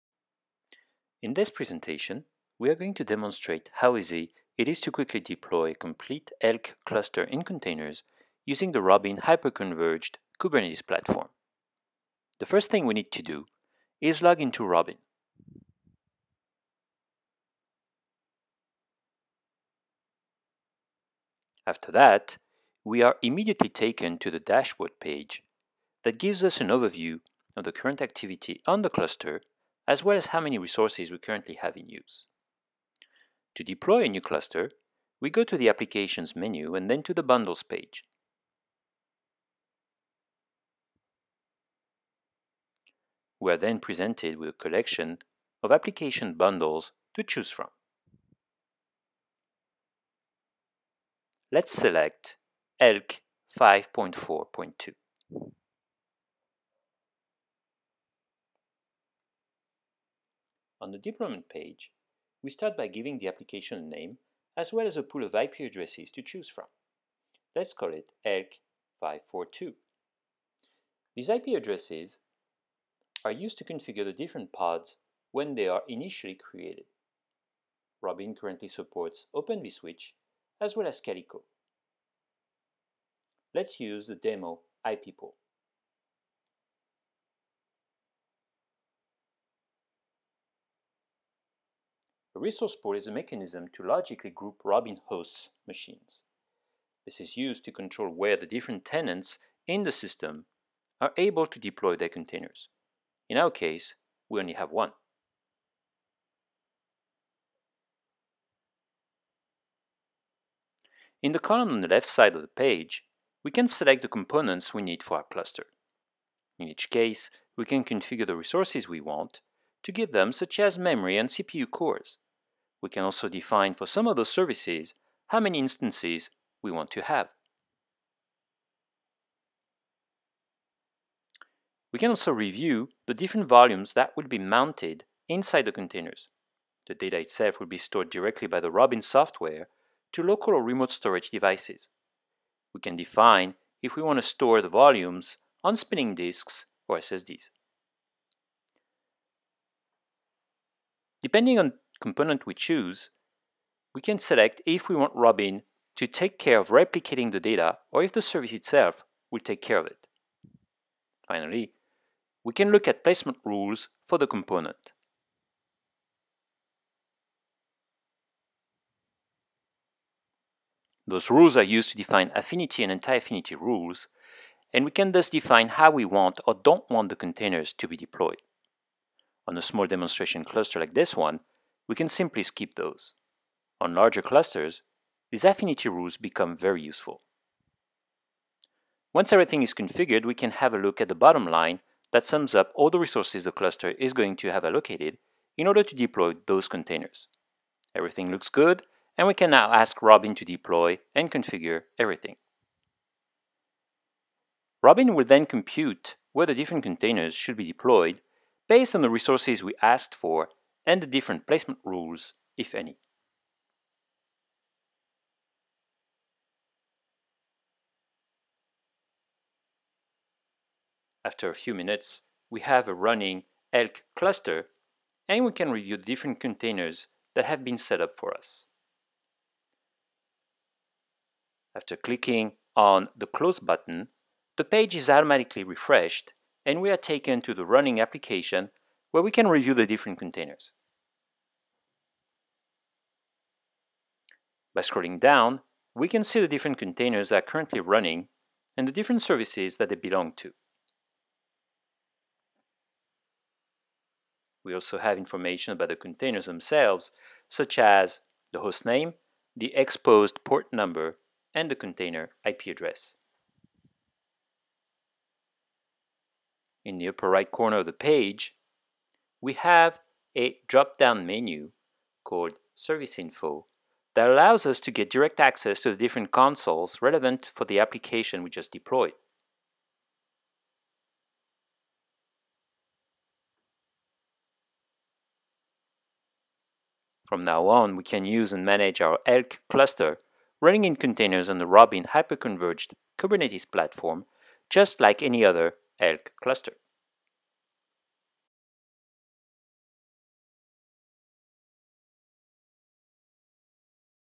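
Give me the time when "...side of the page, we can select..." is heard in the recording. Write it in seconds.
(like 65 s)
112 s.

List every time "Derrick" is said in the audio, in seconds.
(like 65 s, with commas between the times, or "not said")
not said.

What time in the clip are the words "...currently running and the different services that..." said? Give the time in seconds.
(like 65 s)
247 s.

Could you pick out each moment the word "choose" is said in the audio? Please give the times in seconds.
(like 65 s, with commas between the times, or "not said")
47 s, 66 s, 152 s.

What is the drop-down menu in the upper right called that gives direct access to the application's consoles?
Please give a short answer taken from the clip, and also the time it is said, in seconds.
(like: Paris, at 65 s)
Service Info, at 272 s.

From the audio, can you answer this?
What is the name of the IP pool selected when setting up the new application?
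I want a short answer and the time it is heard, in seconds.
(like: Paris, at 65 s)
demo IP pool, at 84 s.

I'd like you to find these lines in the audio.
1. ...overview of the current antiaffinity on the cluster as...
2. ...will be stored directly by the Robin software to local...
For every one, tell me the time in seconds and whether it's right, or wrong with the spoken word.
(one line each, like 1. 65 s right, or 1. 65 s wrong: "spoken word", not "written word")
1. 26 s wrong: "activity", not "antiaffinity"
2. 137 s right.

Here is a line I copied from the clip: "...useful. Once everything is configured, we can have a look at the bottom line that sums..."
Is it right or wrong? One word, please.
right.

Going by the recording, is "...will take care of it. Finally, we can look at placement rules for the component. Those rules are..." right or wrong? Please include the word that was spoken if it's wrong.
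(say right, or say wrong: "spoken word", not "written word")
right.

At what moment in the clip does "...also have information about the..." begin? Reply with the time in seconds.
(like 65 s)
254 s.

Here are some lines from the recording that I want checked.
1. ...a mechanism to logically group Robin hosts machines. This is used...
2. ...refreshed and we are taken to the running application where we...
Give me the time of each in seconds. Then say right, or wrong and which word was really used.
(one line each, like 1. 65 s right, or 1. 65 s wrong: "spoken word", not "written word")
1. 93 s right
2. 235 s right.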